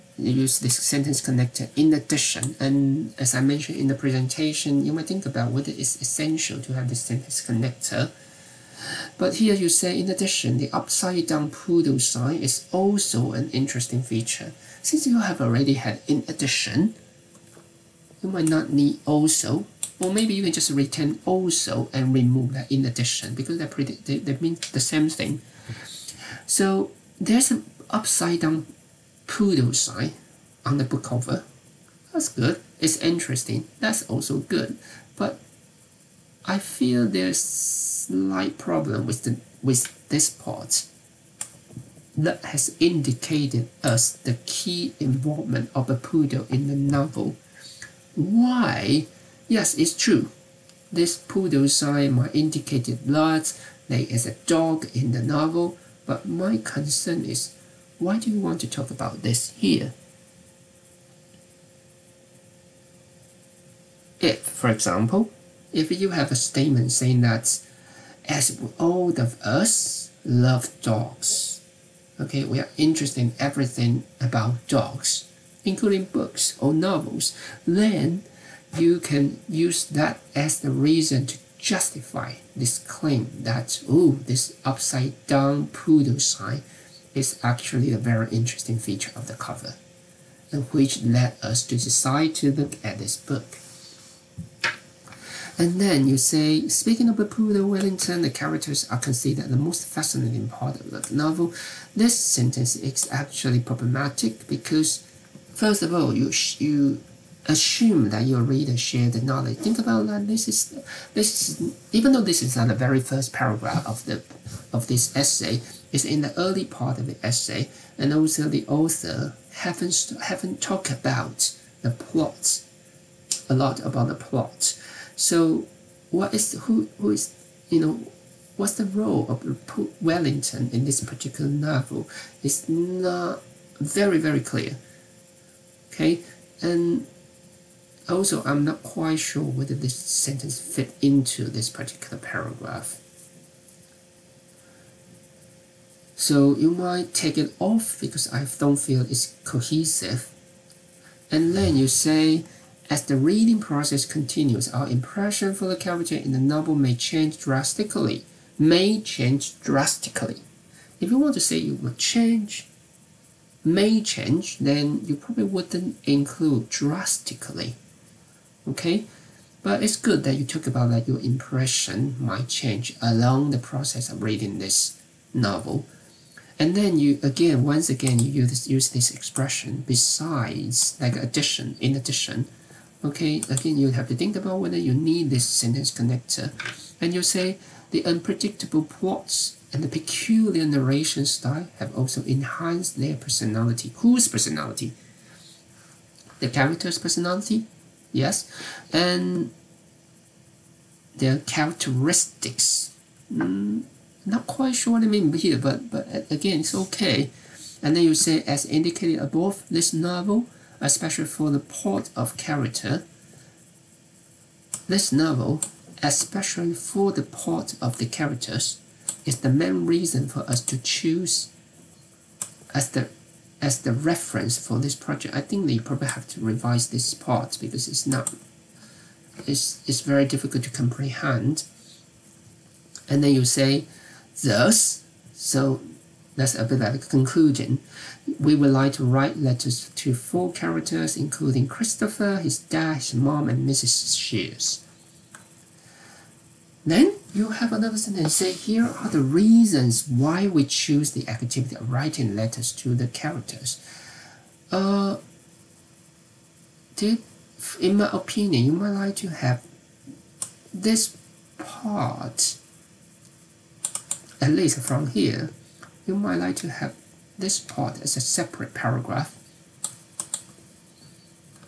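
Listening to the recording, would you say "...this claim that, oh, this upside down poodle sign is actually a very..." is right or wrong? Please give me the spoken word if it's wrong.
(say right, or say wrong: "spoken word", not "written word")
right.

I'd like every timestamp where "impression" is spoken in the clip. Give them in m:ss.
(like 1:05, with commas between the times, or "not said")
2:34, 2:51.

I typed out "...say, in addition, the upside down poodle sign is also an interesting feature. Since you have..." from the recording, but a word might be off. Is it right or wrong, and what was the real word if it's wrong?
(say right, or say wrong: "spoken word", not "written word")
right.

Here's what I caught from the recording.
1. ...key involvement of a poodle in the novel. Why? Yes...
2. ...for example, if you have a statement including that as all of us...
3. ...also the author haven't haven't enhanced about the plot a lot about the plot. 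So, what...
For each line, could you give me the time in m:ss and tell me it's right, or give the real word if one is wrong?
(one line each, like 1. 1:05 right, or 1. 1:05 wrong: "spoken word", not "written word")
1. 0:44 right
2. 1:04 wrong: "saying", not "including"
3. 1:58 wrong: "talked", not "enhanced".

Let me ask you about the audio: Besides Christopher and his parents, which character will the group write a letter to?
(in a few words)
Mrs. Shears.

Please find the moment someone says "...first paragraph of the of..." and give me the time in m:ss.
1:52.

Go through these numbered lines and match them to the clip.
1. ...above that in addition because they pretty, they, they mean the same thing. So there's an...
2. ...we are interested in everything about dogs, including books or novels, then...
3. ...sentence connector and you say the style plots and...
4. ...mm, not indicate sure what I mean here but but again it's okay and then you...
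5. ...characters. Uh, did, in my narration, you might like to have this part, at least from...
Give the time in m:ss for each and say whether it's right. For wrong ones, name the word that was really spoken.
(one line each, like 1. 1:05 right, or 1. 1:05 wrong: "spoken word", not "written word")
1. 0:22 wrong: "remove", not "above"
2. 1:12 right
3. 3:05 wrong: "unpredictable", not "style"
4. 3:23 wrong: "quite", not "indicate"
5. 4:13 wrong: "opinion", not "narration".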